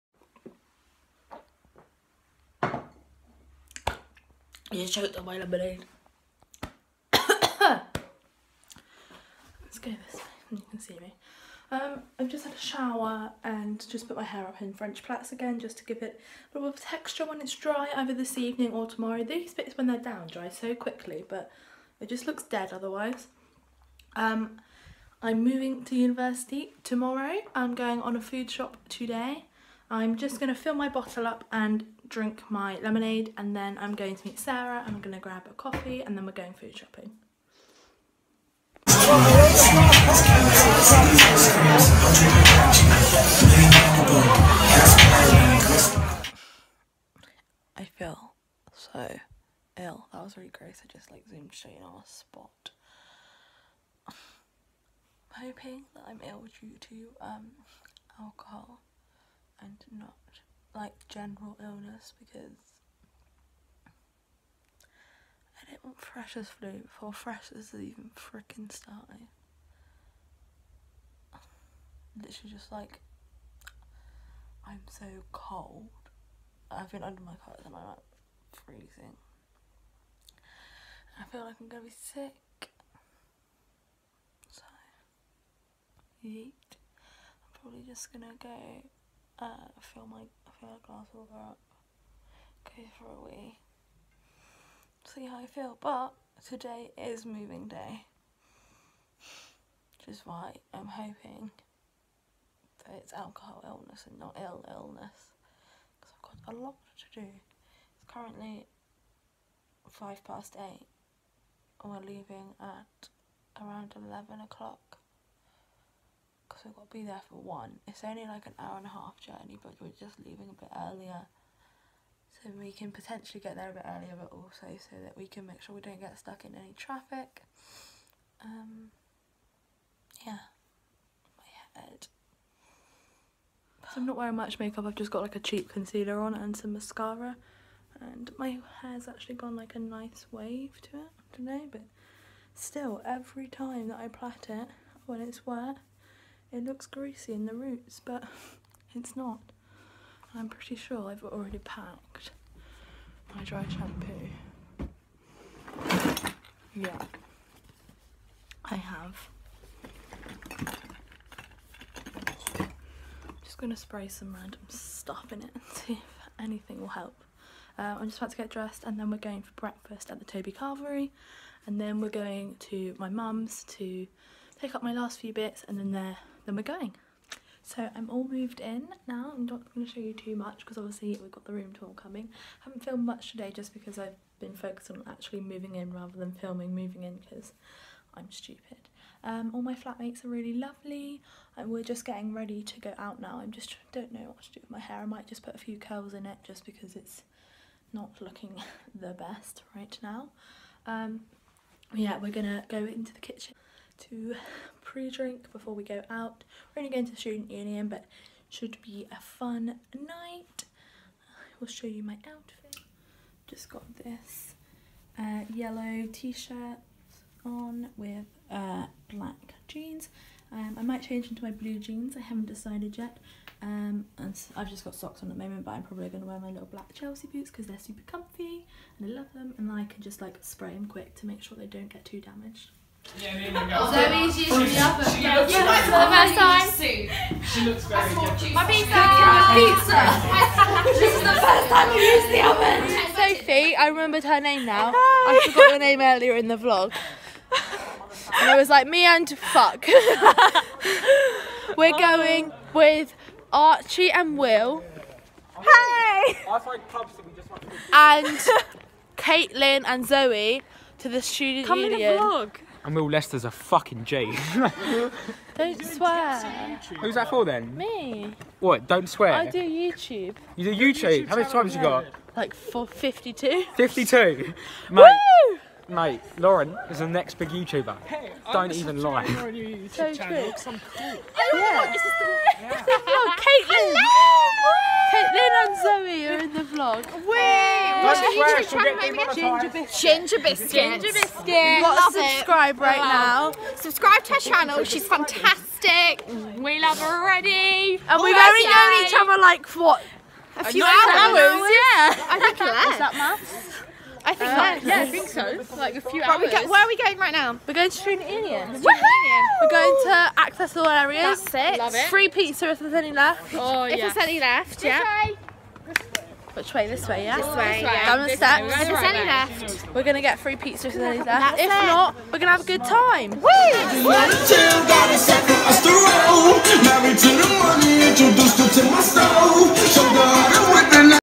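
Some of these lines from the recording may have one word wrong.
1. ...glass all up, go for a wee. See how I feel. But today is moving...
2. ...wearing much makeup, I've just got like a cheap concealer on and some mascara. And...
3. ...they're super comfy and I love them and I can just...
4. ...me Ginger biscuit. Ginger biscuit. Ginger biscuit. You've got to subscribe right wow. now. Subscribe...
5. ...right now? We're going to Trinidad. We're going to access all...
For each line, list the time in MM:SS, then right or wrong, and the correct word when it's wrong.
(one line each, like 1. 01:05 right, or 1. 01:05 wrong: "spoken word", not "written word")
1. 01:30 right
2. 02:14 right
3. 03:47 right
4. 04:49 right
5. 05:07 right.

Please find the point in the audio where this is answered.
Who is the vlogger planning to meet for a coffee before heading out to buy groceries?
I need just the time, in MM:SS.
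00:34.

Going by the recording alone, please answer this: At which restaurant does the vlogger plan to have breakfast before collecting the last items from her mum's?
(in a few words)
Toby Carvery.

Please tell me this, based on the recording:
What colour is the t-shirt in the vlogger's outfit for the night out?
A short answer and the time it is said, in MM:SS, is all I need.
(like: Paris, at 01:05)
Yellow, at 03:35.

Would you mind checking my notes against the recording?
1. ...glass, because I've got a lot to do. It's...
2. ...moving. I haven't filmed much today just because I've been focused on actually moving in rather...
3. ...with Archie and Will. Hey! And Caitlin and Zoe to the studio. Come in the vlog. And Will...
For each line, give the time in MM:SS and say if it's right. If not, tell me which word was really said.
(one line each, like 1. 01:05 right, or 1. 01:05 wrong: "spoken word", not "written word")
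1. 01:44 wrong: "illness", not "glass"
2. 03:01 wrong: "coming", not "moving"
3. 04:12 right.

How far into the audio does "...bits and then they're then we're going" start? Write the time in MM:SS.
02:55.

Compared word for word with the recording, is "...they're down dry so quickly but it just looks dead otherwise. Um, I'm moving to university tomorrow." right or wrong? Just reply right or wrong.
right.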